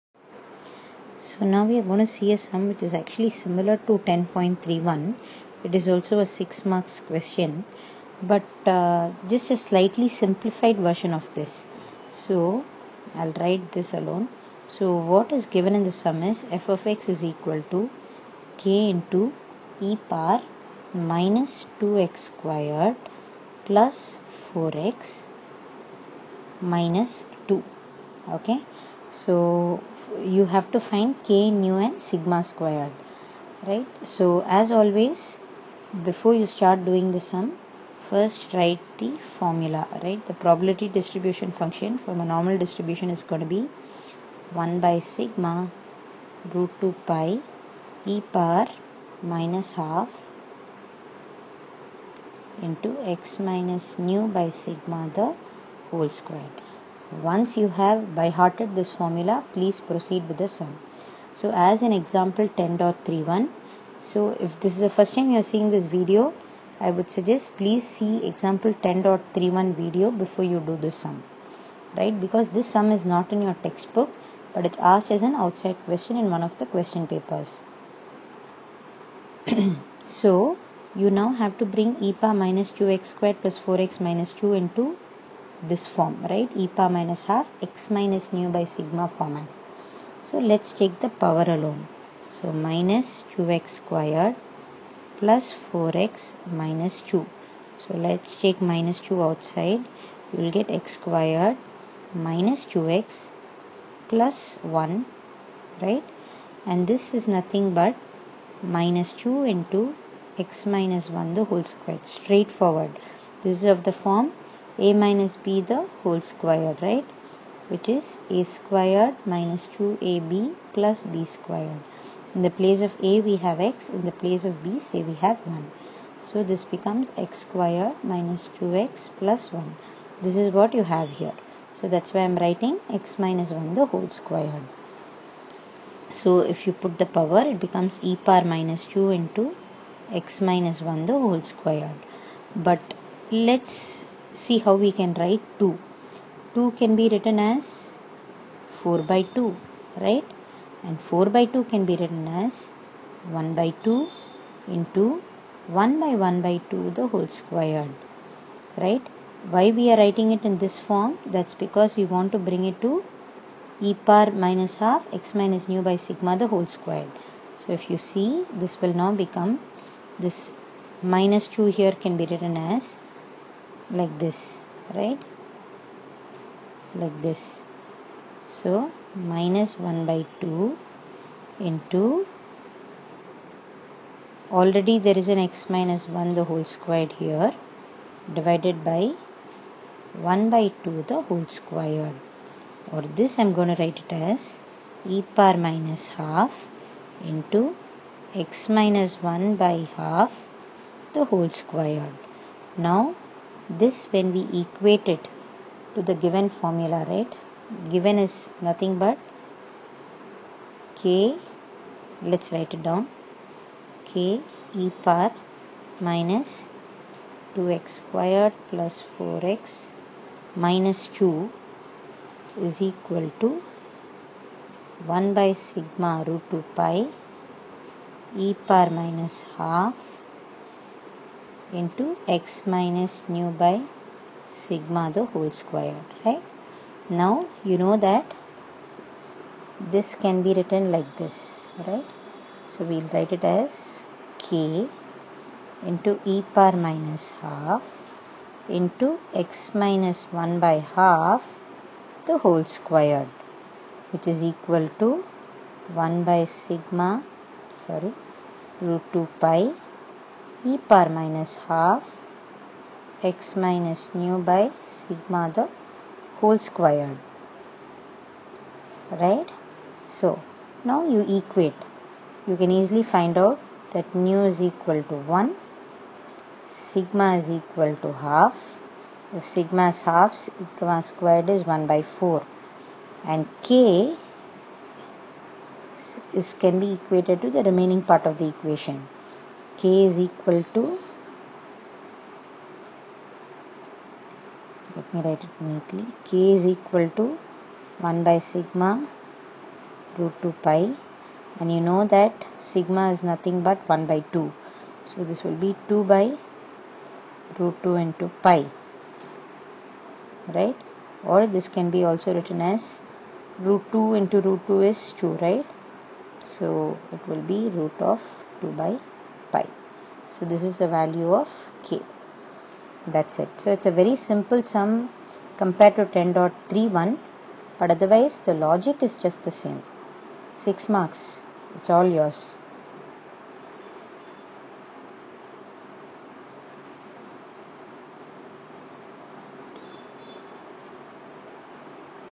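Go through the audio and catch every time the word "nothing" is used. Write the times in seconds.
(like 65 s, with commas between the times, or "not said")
107 s, 208 s, 303 s.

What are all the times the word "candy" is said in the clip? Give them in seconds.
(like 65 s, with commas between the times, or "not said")
not said.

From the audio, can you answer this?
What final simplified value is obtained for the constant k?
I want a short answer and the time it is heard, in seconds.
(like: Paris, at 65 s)
root of 2 by pi, at 317 s.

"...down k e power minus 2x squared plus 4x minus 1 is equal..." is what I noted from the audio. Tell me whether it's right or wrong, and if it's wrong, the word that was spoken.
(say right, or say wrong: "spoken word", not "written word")
wrong: "2", not "1".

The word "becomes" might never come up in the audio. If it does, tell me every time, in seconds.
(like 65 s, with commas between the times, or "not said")
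126 s, 137 s, 169 s.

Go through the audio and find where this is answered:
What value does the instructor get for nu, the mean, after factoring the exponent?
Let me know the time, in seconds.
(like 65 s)
274 s.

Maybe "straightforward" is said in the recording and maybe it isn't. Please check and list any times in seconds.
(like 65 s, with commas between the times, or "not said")
112 s.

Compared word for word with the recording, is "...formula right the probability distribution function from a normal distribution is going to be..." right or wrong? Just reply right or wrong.
right.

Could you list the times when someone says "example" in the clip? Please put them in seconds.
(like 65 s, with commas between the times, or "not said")
61 s, 68 s.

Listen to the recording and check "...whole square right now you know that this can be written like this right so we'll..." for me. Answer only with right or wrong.
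right.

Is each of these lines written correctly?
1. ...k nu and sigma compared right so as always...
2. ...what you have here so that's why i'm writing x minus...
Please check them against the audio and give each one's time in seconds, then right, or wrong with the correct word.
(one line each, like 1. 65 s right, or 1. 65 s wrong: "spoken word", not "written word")
1. 31 s wrong: "squared", not "compared"
2. 130 s right.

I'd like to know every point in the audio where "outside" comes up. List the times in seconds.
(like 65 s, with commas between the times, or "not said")
75 s, 99 s.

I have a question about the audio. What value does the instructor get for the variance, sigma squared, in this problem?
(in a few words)
1/4.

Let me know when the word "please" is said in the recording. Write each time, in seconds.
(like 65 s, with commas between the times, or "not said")
59 s, 67 s.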